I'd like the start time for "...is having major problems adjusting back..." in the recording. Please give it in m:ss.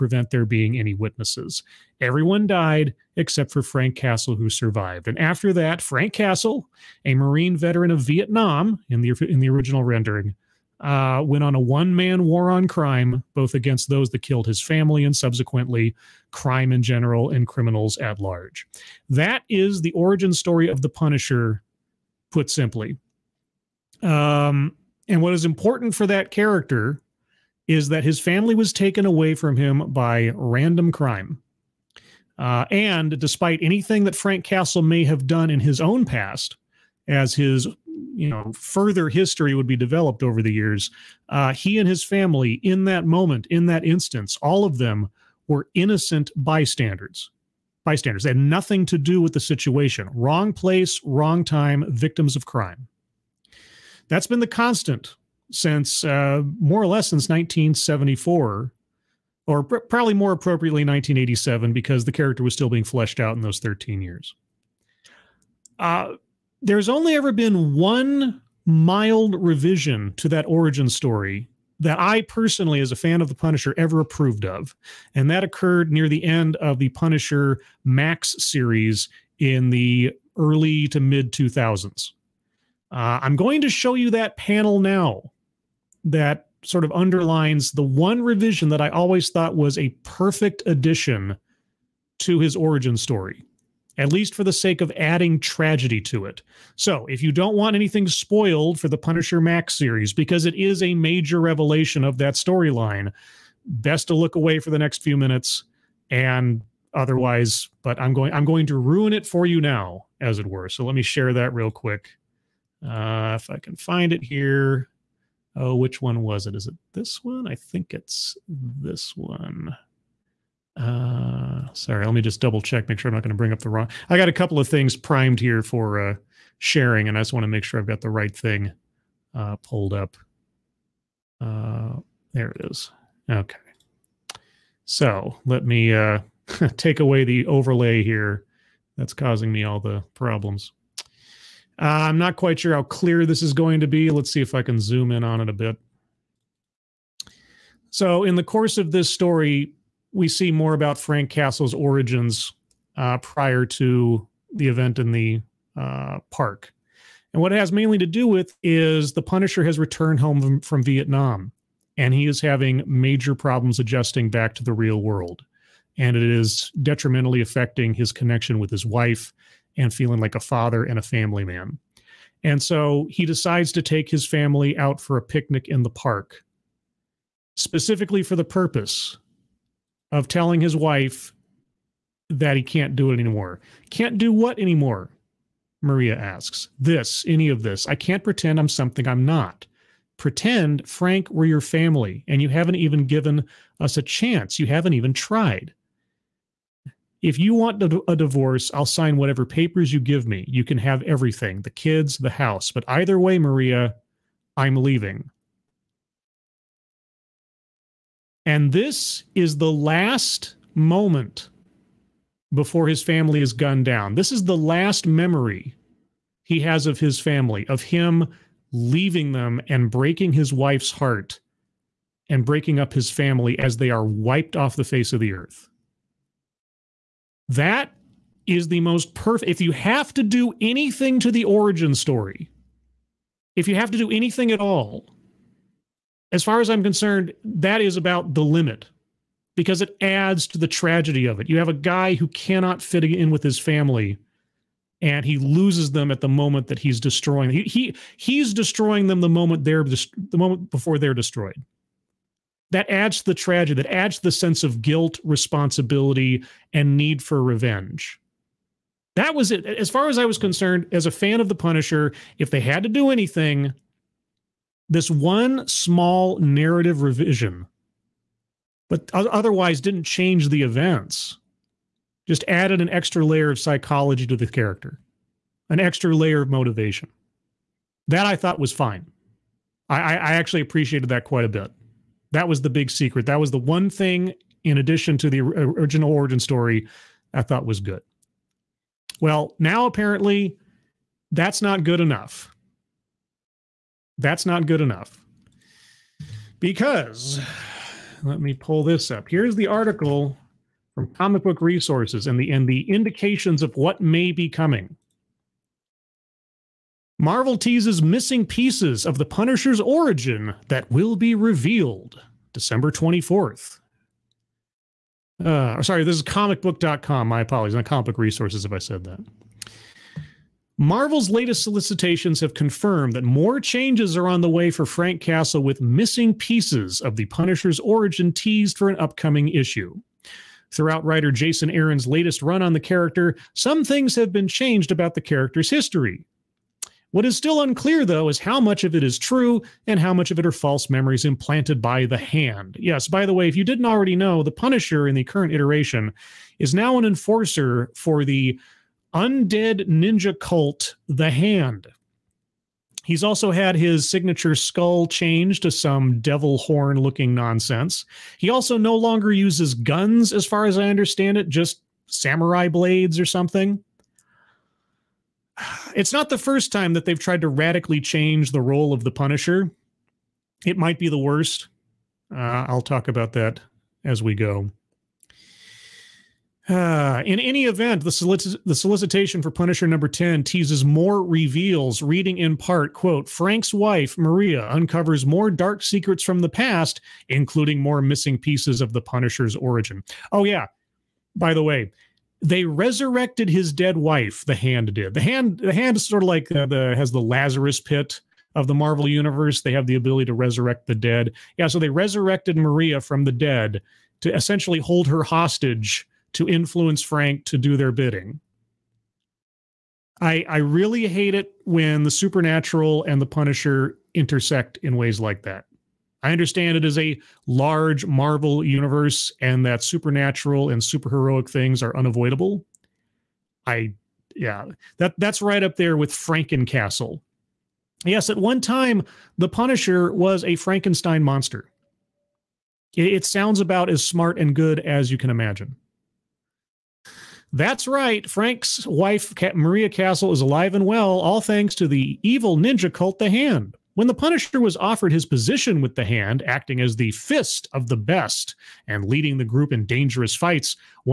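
2:42.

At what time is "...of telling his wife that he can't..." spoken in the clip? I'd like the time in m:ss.
3:00.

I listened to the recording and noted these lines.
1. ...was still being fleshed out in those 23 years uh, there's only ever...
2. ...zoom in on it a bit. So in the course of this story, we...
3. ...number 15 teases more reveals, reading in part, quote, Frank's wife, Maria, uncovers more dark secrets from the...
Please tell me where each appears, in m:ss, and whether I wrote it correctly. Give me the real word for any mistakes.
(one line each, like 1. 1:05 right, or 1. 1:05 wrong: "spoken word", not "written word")
1. 1:02 wrong: "13", not "23"
2. 2:24 right
3. 6:19 wrong: "10", not "15".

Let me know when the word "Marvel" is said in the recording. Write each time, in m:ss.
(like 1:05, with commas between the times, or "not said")
5:07, 5:20, 6:38, 6:58.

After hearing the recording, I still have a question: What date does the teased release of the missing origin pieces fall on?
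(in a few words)
December 24th.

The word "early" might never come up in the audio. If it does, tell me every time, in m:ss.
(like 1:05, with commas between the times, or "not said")
1:20.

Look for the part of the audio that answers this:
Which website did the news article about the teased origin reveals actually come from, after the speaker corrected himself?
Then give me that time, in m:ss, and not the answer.
5:16.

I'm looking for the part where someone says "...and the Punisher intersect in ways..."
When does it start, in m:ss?
6:53.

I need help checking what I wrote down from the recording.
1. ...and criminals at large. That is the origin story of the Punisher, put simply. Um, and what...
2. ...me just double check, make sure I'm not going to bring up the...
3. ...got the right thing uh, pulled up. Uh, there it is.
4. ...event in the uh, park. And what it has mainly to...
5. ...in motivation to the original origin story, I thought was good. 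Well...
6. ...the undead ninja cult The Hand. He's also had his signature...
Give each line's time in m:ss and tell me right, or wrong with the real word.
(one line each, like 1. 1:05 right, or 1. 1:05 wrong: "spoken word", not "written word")
1. 0:17 right
2. 2:02 right
3. 2:07 right
4. 2:34 right
5. 4:44 wrong: "addition", not "motivation"
6. 5:48 right.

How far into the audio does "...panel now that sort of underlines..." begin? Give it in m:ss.
1:24.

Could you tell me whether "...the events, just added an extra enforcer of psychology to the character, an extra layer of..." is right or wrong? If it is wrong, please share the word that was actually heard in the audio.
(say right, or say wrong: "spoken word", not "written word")
wrong: "layer", not "enforcer".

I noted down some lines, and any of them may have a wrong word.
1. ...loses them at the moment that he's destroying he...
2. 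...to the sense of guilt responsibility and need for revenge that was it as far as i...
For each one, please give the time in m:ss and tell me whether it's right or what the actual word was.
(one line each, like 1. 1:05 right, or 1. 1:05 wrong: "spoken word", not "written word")
1. 4:05 right
2. 4:14 right.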